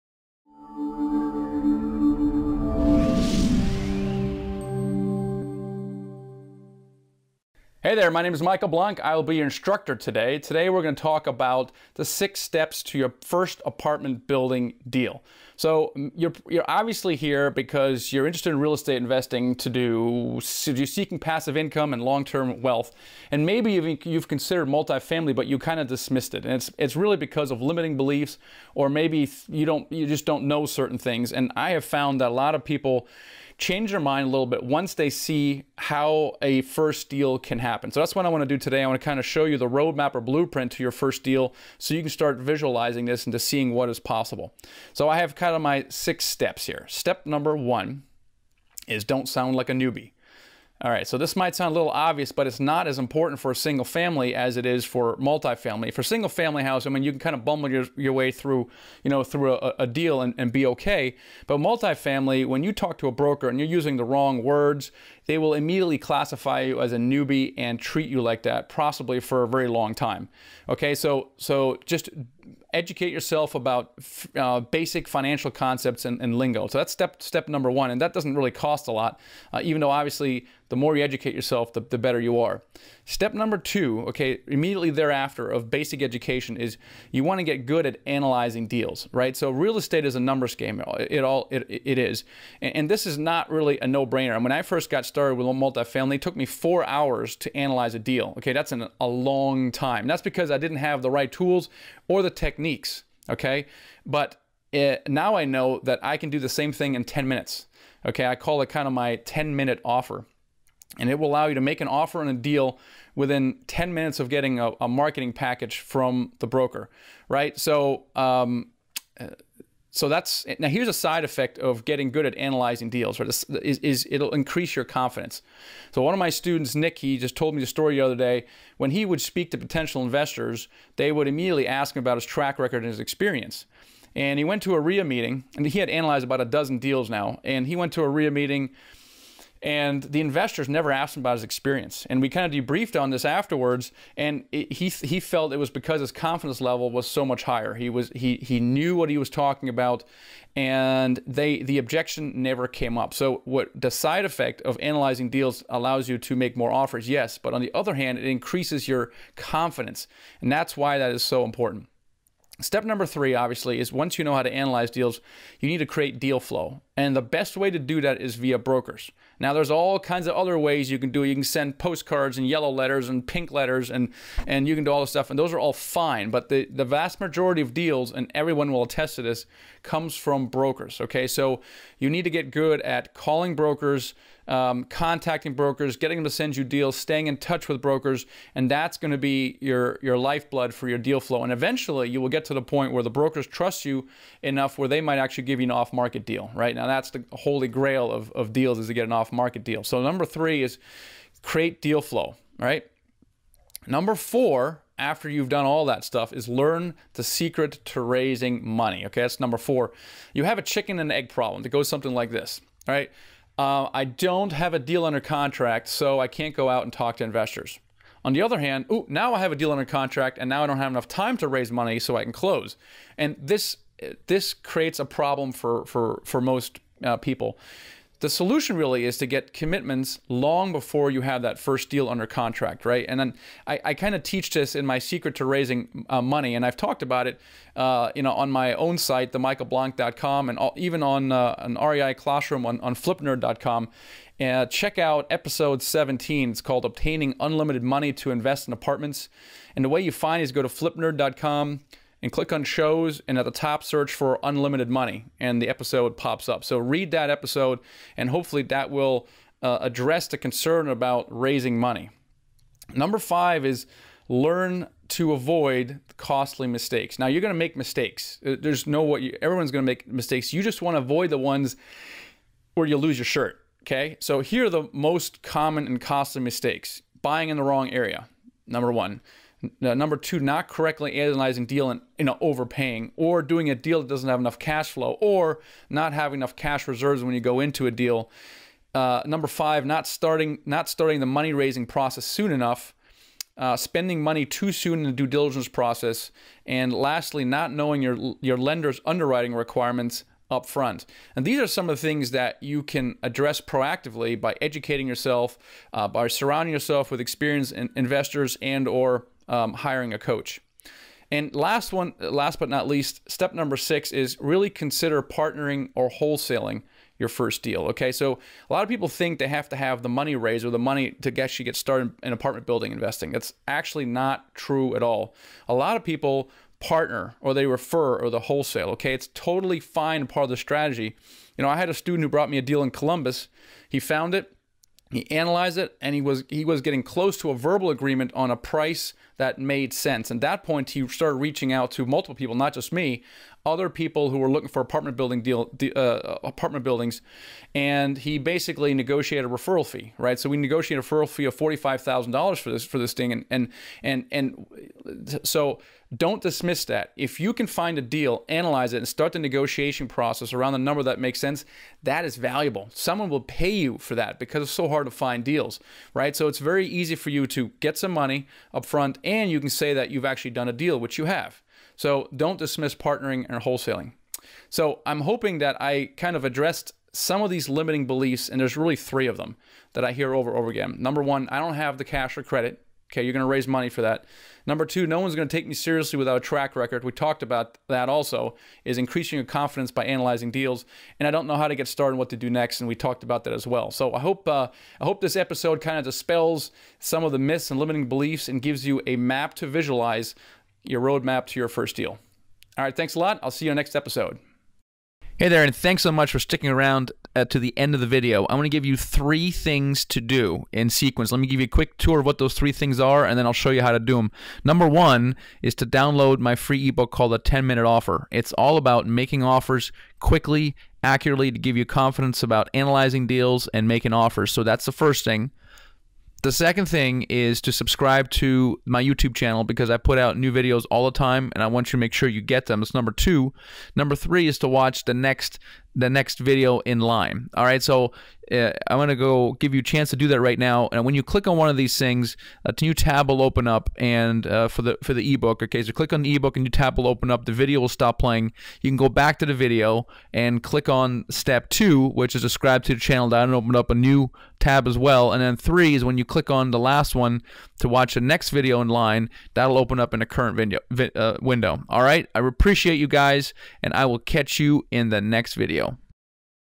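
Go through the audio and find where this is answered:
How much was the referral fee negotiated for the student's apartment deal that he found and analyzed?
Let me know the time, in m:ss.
5:51.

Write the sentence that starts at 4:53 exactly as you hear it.
Uh, spending money too soon in the due diligence process, and lastly, not knowing your your lender's underwriting requirements up front.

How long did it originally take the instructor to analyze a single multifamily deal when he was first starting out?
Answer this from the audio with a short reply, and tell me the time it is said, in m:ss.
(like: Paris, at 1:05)
4 hours, at 1:36.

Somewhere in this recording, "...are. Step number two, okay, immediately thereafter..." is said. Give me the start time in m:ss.
1:22.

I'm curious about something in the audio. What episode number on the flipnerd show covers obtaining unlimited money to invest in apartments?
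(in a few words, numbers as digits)
17.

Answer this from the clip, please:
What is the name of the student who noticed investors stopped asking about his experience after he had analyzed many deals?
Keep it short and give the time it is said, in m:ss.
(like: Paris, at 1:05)
Nick, at 2:06.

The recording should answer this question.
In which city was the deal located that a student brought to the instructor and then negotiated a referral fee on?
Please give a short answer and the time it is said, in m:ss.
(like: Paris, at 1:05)
Columbus, at 5:32.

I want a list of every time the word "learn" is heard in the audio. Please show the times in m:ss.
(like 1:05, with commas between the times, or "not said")
3:26, 4:24.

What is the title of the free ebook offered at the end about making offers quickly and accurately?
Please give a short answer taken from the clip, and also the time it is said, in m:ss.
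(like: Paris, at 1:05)
The 10 Minute Offer, at 6:57.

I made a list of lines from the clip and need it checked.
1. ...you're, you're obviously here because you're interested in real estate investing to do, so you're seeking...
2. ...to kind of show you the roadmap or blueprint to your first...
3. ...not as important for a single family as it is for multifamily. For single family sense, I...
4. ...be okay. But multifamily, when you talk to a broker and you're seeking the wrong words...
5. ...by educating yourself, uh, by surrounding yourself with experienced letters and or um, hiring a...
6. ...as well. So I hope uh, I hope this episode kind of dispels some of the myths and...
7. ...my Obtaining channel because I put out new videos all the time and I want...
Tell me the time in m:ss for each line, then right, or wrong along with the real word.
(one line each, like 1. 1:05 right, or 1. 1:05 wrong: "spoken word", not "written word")
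1. 0:16 right
2. 0:38 right
3. 0:52 wrong: "house", not "sense"
4. 1:00 wrong: "using", not "seeking"
5. 5:04 wrong: "investors", not "letters"
6. 6:33 right
7. 7:08 wrong: "YouTube", not "Obtaining".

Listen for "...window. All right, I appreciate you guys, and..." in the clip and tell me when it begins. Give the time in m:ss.
7:41.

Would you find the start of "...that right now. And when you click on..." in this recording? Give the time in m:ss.
7:20.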